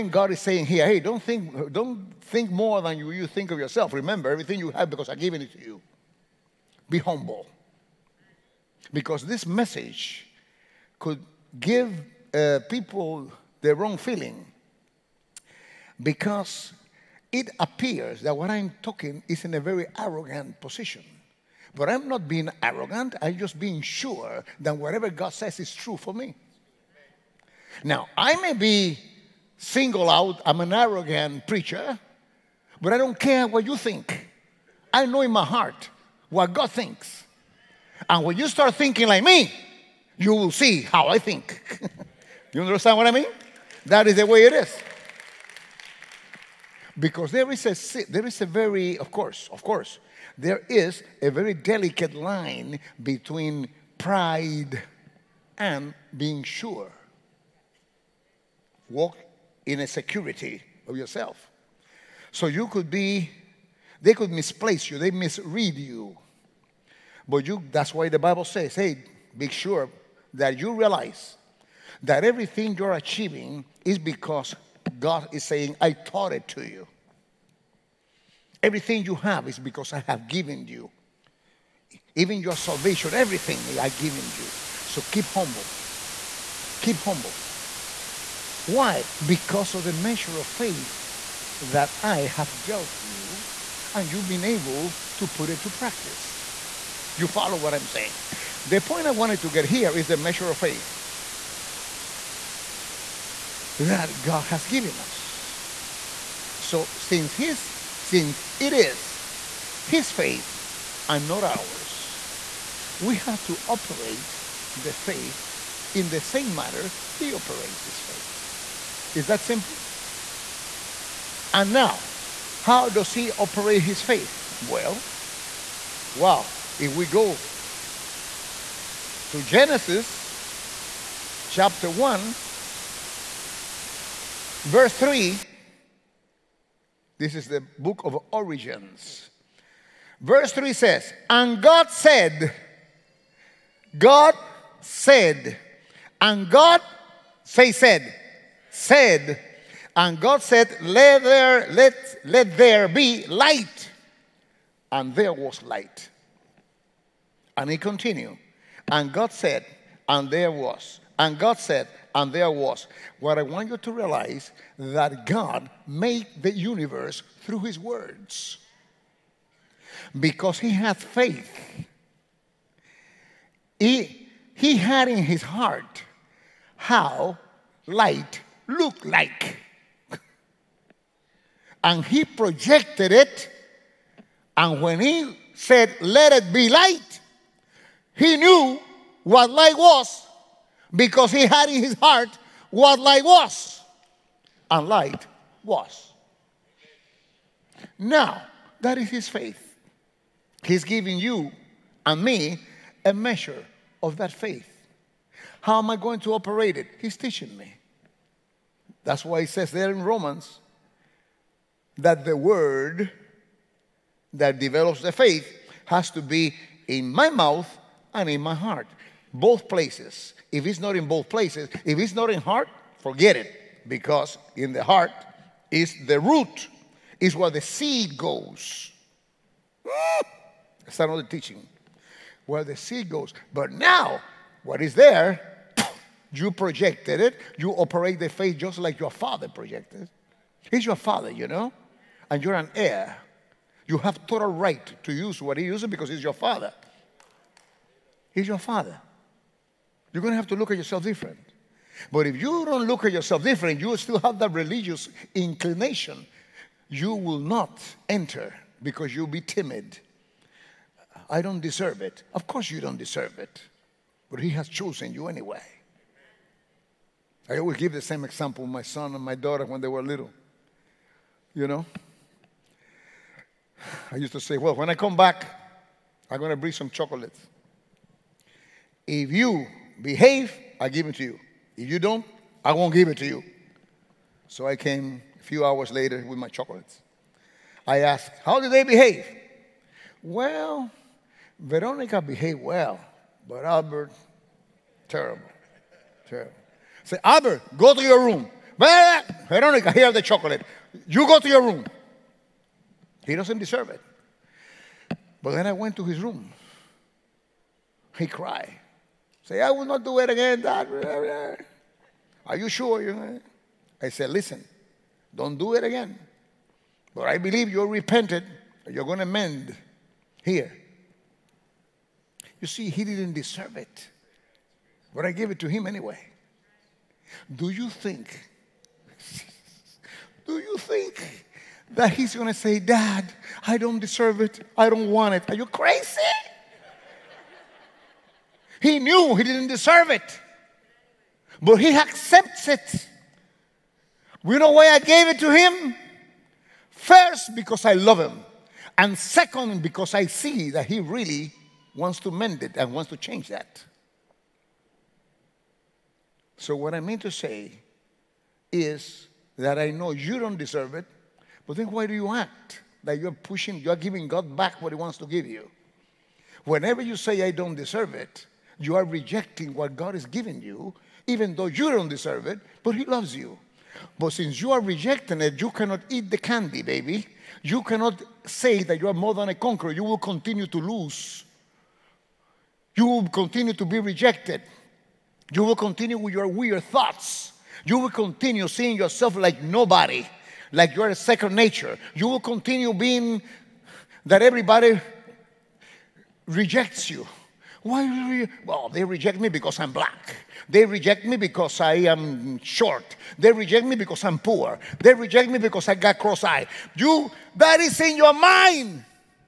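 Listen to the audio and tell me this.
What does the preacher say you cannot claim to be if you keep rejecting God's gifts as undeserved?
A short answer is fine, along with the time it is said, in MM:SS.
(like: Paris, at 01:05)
more than a conqueror, at 06:19.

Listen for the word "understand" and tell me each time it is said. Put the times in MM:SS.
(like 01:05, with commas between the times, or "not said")
00:42.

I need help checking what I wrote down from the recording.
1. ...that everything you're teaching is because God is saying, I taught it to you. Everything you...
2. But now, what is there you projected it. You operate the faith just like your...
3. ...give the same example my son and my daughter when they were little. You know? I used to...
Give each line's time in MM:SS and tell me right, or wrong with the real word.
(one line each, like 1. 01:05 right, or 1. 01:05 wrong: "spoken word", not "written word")
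1. 01:12 wrong: "achieving", not "teaching"
2. 03:53 right
3. 04:27 right.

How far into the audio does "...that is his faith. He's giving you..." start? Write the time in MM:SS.
03:18.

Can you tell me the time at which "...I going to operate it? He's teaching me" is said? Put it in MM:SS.
03:25.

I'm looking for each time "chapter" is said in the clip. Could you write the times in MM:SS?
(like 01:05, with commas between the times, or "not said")
02:11.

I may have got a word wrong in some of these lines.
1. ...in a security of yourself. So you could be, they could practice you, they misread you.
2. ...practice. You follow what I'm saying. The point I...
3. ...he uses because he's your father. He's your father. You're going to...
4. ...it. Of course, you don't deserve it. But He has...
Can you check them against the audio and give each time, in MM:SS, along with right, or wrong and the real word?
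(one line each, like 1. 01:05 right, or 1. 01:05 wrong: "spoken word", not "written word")
1. 00:59 wrong: "misplace", not "practice"
2. 01:35 right
3. 04:05 right
4. 04:22 right.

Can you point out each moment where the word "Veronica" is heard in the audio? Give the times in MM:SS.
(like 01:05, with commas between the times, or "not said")
04:51, 04:58.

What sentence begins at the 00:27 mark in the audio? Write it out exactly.
Now, I may be single out I'm an arrogant preacher, but I don't care what you think.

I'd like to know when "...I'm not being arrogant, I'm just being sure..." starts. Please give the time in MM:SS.
00:21.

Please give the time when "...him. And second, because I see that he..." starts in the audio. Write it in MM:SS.
05:48.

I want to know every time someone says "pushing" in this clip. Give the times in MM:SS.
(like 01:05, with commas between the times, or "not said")
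06:03.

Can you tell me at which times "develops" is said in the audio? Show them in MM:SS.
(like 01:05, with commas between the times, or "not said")
03:34.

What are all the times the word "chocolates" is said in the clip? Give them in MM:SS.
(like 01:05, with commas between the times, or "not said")
04:36, 04:46, 05:00.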